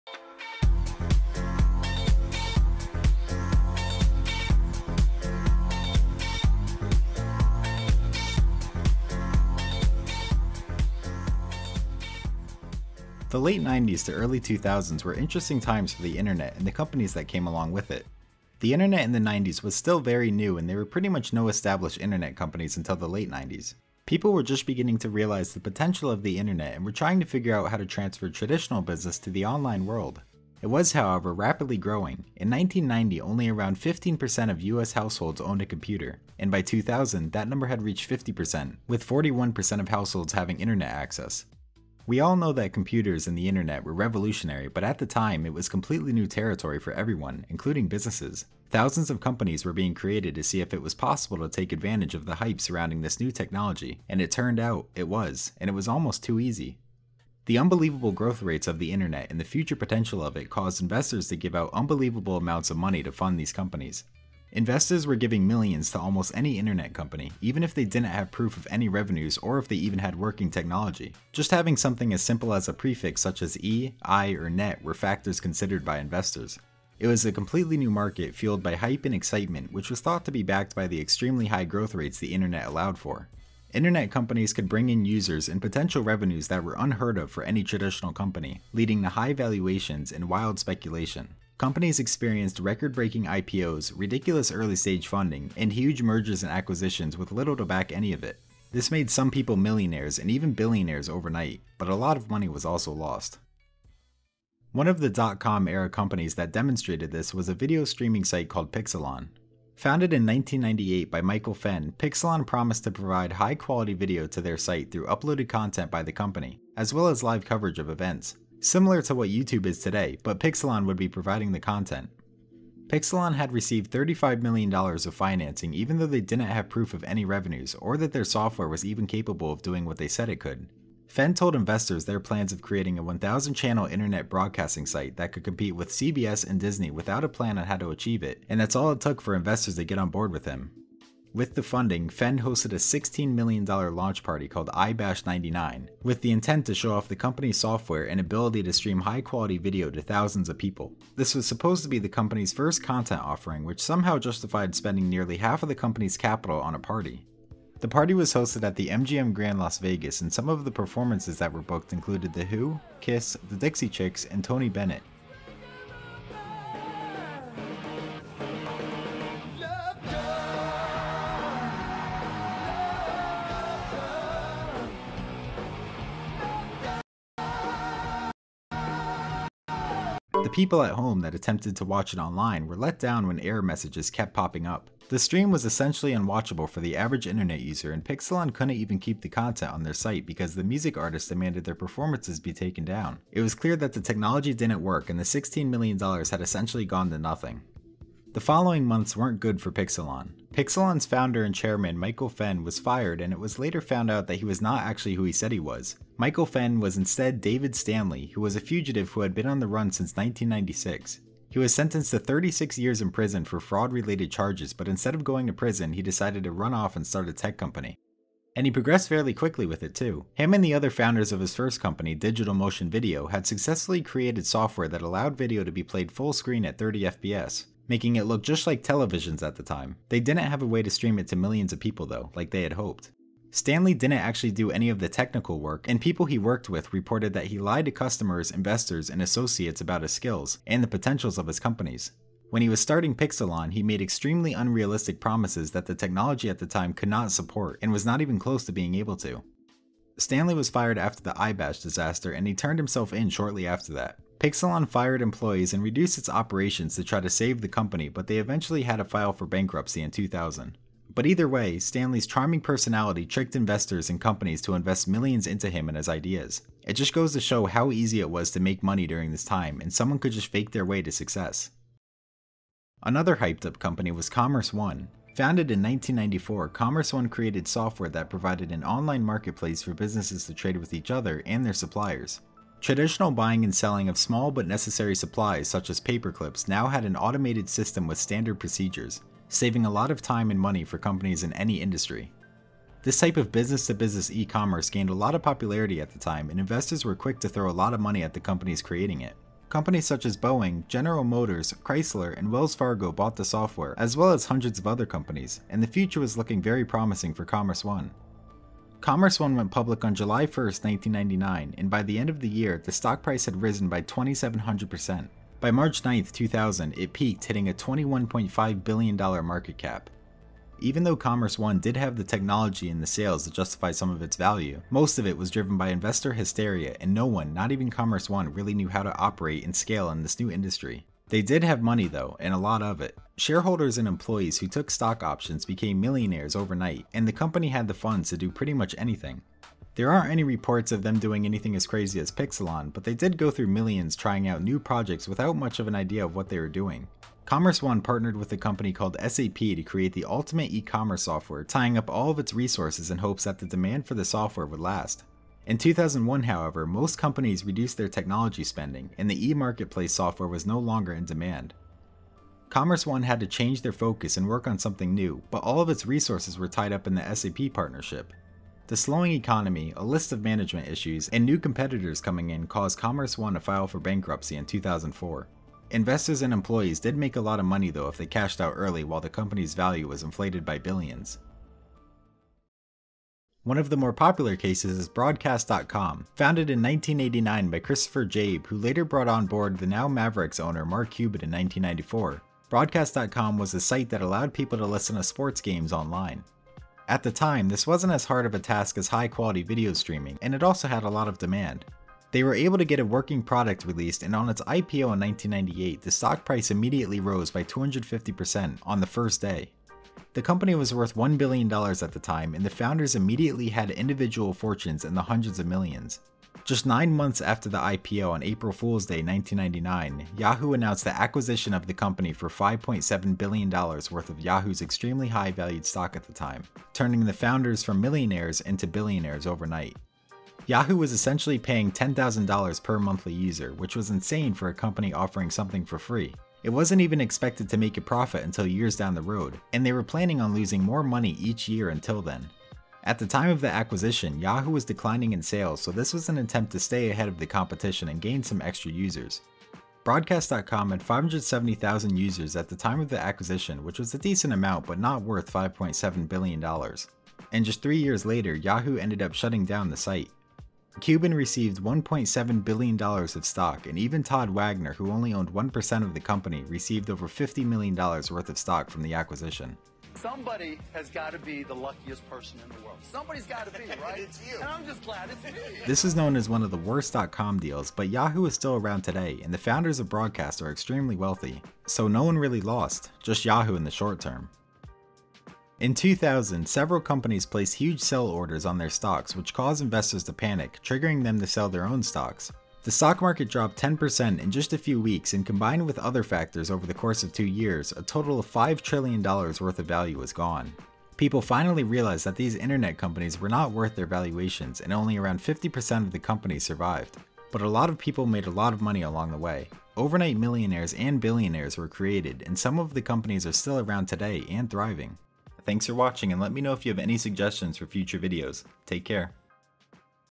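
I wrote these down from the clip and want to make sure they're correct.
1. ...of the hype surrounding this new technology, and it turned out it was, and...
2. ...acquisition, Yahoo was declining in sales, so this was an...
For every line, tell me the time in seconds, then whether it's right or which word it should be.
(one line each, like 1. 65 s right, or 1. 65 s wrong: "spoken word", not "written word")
1. 52 s right
2. 443 s right.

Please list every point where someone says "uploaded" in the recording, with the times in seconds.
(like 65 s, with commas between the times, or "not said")
115 s.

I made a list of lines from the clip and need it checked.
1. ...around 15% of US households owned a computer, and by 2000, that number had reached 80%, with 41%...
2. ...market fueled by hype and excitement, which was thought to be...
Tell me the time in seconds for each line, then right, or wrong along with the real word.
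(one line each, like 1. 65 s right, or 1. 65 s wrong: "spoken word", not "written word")
1. 33 s wrong: "50", not "80"
2. 77 s right.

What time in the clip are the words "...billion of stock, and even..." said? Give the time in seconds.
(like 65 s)
462 s.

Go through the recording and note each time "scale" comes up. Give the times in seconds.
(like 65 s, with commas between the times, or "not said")
329 s.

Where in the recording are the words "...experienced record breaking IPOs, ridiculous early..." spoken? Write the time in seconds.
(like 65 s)
91 s.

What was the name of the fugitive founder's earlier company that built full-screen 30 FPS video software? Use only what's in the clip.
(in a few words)
Digital Motion Video.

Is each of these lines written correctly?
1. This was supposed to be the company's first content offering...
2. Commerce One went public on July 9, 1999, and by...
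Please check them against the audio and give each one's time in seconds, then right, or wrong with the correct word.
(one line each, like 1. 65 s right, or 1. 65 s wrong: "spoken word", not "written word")
1. 151 s right
2. 309 s wrong: "1", not "9".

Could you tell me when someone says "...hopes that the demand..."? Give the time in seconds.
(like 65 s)
353 s.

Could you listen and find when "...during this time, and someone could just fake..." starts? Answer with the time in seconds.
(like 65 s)
269 s.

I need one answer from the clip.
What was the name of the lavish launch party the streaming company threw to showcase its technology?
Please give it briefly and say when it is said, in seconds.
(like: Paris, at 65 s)
iBash 99, at 144 s.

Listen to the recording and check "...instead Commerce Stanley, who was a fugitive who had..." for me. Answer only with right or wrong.
wrong.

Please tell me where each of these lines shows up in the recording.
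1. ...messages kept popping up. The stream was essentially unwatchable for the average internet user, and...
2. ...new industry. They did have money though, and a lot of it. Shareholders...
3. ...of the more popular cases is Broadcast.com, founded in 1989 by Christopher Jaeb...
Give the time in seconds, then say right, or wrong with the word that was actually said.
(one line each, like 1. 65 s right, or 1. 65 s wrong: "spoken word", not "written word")
1. 183 s right
2. 330 s right
3. 383 s right.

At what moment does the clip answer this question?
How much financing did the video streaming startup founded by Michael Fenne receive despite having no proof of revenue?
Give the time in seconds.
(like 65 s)
123 s.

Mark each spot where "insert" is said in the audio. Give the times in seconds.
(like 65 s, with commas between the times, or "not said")
not said.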